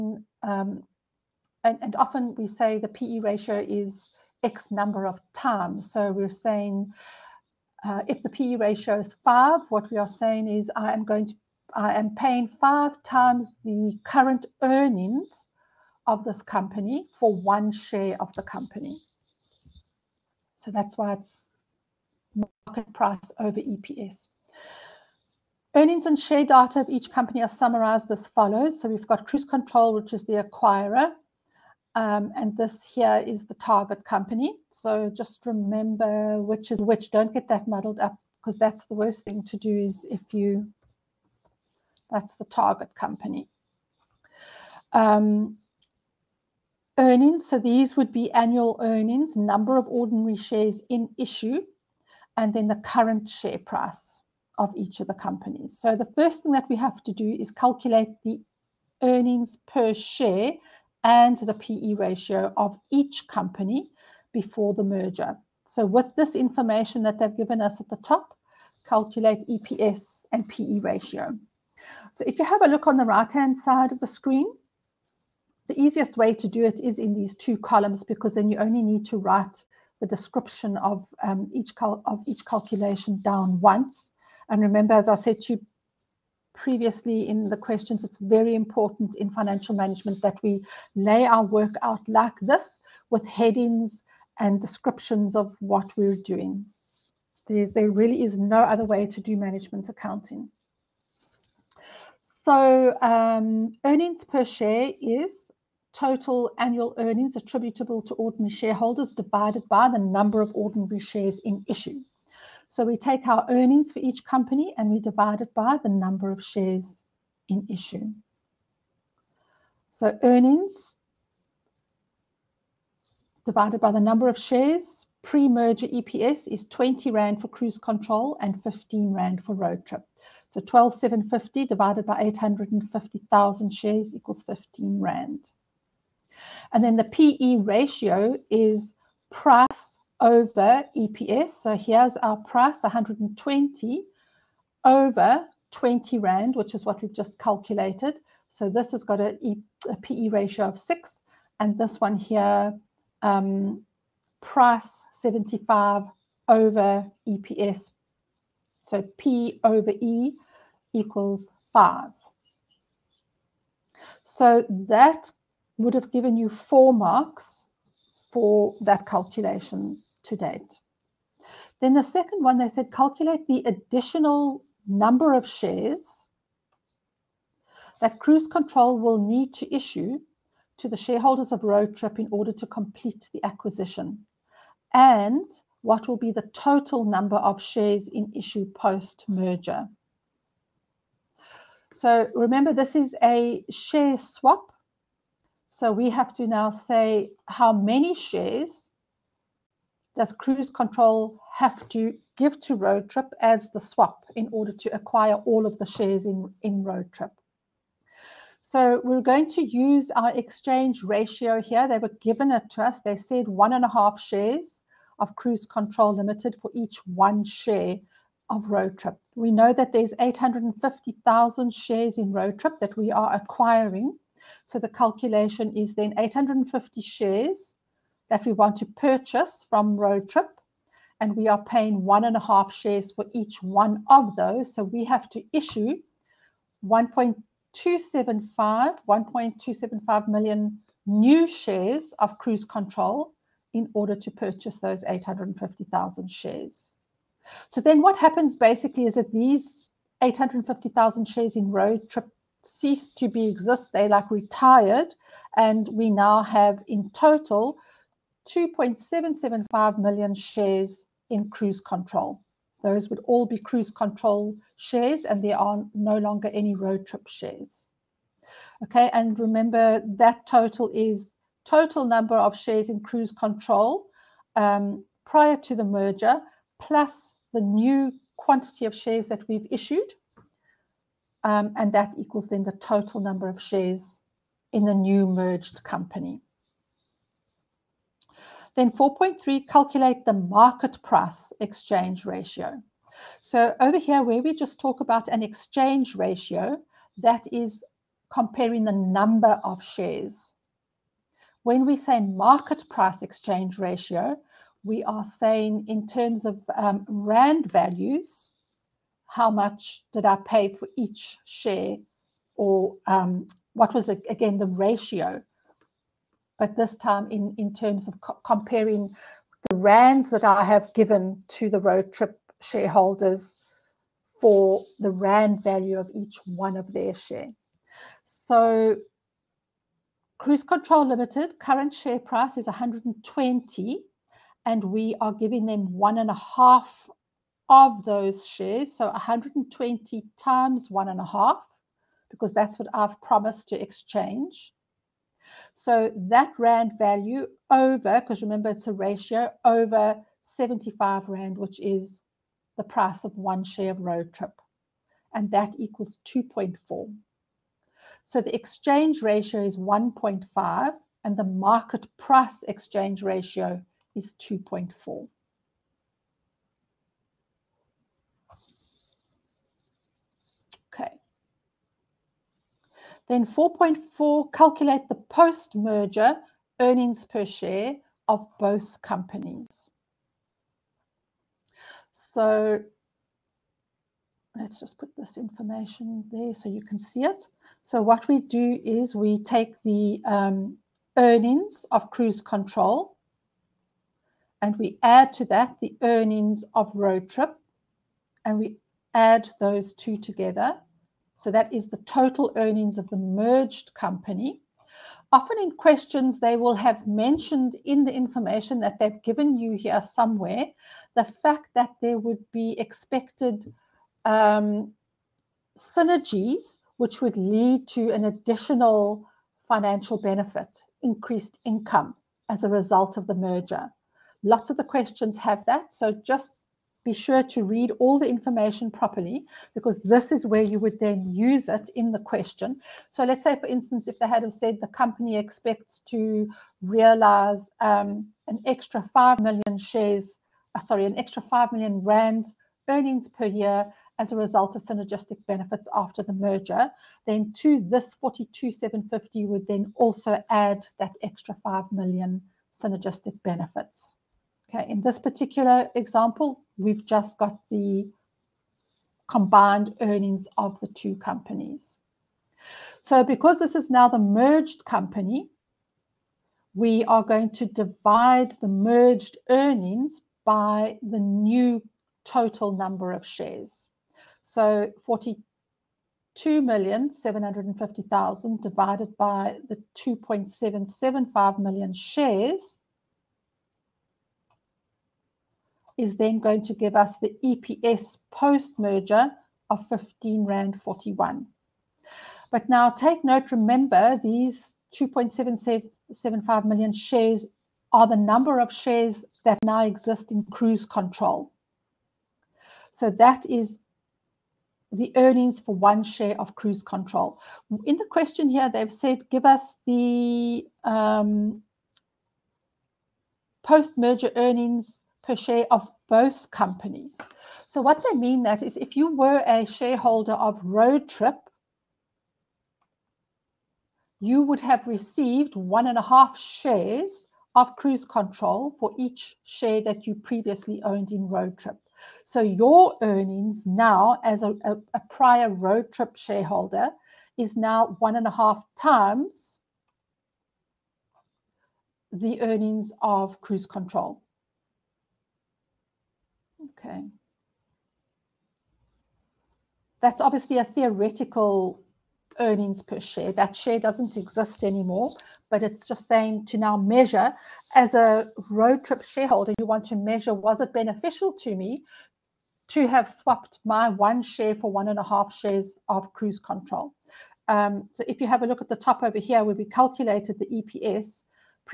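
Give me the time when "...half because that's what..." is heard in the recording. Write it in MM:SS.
05:41.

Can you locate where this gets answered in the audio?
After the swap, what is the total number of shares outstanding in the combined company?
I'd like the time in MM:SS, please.
04:18.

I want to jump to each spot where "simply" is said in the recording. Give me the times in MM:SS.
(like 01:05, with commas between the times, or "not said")
not said.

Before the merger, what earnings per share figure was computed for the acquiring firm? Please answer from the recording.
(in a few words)
20 Rand.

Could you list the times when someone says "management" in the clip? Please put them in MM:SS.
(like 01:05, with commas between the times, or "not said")
01:29, 01:39.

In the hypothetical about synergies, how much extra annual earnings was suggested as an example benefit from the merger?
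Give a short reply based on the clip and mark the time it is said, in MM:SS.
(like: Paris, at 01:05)
5 million rand, at 07:21.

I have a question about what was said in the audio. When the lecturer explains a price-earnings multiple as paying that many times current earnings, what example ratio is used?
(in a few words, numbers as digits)
5.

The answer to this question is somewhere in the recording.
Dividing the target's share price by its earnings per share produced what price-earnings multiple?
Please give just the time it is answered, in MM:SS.
02:39.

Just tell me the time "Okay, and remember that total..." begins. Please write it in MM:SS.
04:28.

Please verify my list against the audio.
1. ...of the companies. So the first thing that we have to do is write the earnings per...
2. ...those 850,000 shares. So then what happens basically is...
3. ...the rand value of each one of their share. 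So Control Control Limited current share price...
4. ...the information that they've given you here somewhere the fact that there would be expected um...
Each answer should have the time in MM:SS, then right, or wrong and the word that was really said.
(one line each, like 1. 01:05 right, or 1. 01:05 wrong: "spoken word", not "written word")
1. 00:54 wrong: "calculate", not "write"
2. 04:04 right
3. 05:24 wrong: "Cruise", not "Control"
4. 06:48 right.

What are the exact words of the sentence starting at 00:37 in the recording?
Don't get that muddled up because that's the worst thing to do is if you, that's the target company.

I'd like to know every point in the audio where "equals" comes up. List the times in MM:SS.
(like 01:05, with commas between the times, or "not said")
02:14, 02:40, 04:42, 05:55.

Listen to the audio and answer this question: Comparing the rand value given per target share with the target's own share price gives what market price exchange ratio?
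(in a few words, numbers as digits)
2.4.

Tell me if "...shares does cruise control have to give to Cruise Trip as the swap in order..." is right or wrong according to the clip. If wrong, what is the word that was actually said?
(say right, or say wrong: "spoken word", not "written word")
wrong: "Road", not "Cruise".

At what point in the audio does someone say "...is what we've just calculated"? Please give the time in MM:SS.
02:26.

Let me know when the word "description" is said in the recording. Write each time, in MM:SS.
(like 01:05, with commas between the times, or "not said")
01:20, 01:34.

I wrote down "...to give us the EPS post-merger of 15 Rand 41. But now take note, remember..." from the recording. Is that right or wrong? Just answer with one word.
right.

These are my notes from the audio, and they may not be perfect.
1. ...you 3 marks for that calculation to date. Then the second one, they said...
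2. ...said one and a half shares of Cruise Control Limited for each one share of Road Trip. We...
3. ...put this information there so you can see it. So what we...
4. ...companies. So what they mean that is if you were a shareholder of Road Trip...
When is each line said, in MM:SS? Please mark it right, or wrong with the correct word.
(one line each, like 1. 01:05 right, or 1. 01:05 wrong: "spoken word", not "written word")
1. 02:46 wrong: "4", not "3"
2. 03:33 right
3. 06:24 right
4. 08:36 right.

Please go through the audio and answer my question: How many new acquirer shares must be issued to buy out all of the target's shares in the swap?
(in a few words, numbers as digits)
1.275 million.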